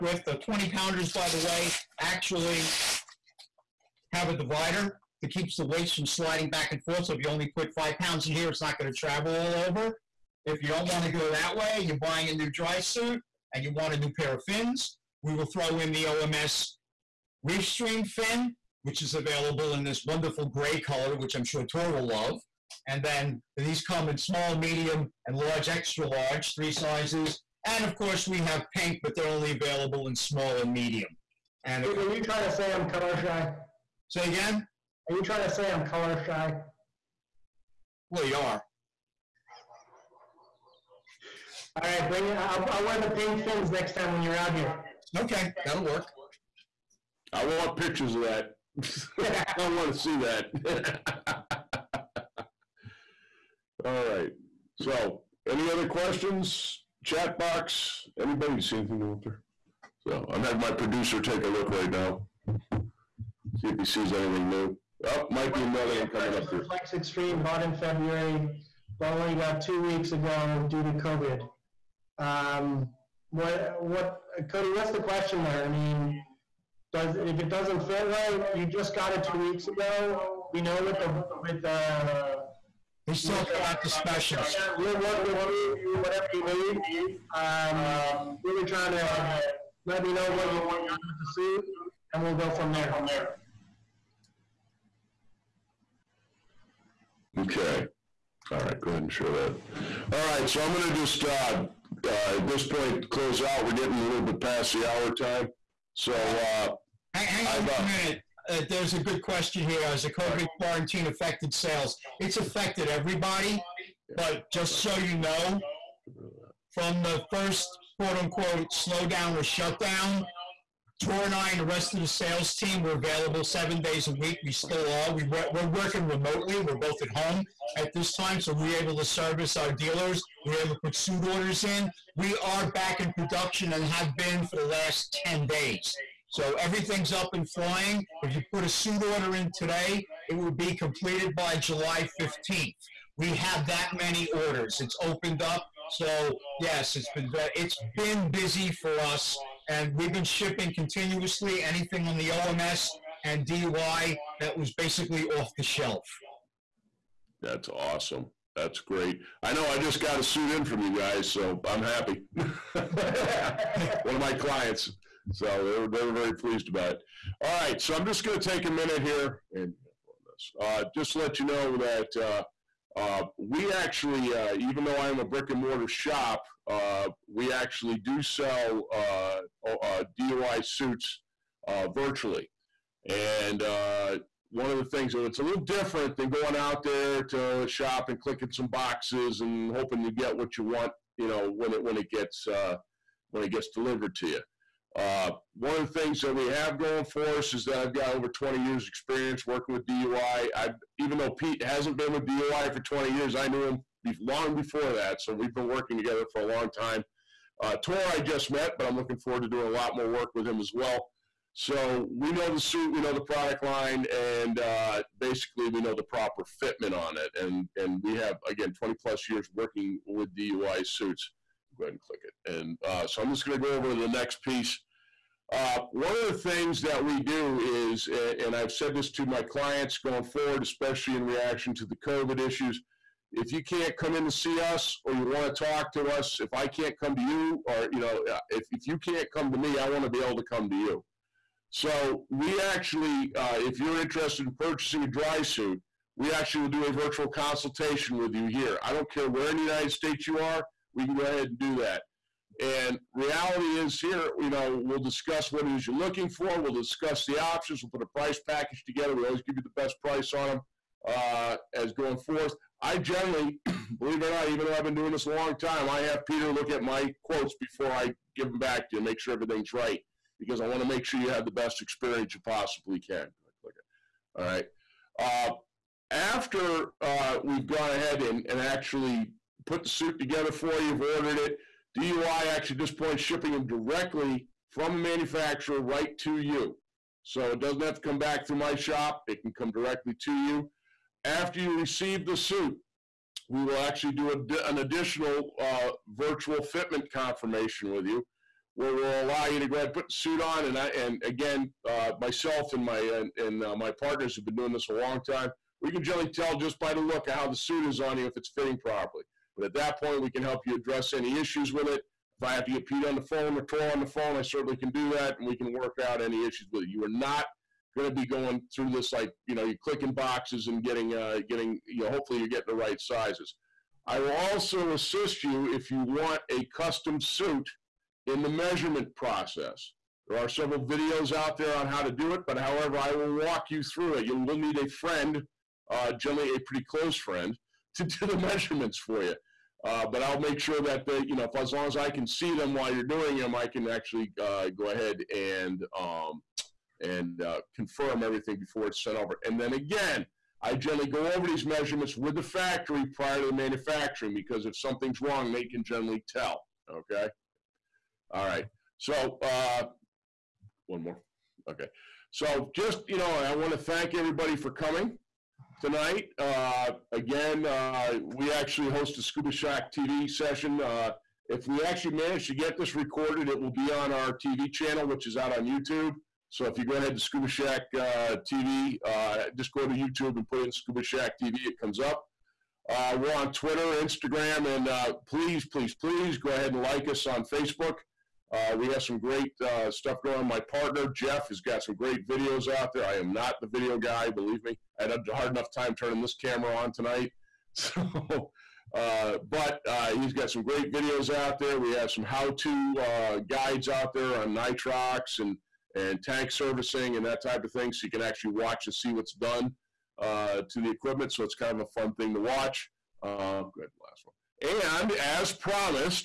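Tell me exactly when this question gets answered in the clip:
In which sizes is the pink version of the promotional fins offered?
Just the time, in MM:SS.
00:30.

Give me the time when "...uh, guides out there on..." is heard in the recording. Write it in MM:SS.
06:42.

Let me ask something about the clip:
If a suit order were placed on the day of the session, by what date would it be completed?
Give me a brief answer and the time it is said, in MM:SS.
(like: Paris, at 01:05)
July 15th, at 02:21.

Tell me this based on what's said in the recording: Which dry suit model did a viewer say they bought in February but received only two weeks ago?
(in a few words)
FLX Extreme.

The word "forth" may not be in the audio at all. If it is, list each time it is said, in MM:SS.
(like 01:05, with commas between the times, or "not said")
00:06, 04:22.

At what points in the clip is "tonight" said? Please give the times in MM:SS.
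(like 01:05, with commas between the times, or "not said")
06:05, 06:36.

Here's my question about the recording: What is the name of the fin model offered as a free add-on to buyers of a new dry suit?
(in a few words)
OMS Reef Stream.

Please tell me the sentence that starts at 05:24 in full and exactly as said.
I will also assist you if you want a custom suit in the measurement process.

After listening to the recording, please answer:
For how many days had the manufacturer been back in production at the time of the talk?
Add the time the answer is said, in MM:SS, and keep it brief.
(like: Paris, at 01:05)
10, at 02:15.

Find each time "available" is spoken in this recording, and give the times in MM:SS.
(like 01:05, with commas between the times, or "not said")
00:19, 00:29, 02:02.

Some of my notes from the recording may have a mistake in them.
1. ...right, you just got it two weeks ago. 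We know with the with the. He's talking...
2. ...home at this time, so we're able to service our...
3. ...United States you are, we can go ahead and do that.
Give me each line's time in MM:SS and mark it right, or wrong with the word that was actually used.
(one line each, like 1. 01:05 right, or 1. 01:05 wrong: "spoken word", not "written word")
1. 01:18 right
2. 02:07 right
3. 04:09 right.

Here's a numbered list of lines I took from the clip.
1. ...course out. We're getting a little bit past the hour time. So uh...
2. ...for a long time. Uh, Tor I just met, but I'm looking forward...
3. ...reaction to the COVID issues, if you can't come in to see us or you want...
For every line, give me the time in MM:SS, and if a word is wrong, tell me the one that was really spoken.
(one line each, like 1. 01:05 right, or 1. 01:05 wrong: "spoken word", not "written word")
1. 01:43 wrong: "close", not "course"
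2. 03:26 right
3. 03:51 right.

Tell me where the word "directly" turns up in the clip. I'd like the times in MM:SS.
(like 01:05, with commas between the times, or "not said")
04:43, 04:49.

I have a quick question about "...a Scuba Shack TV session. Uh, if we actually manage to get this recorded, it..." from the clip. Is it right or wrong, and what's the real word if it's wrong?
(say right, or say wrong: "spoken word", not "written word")
right.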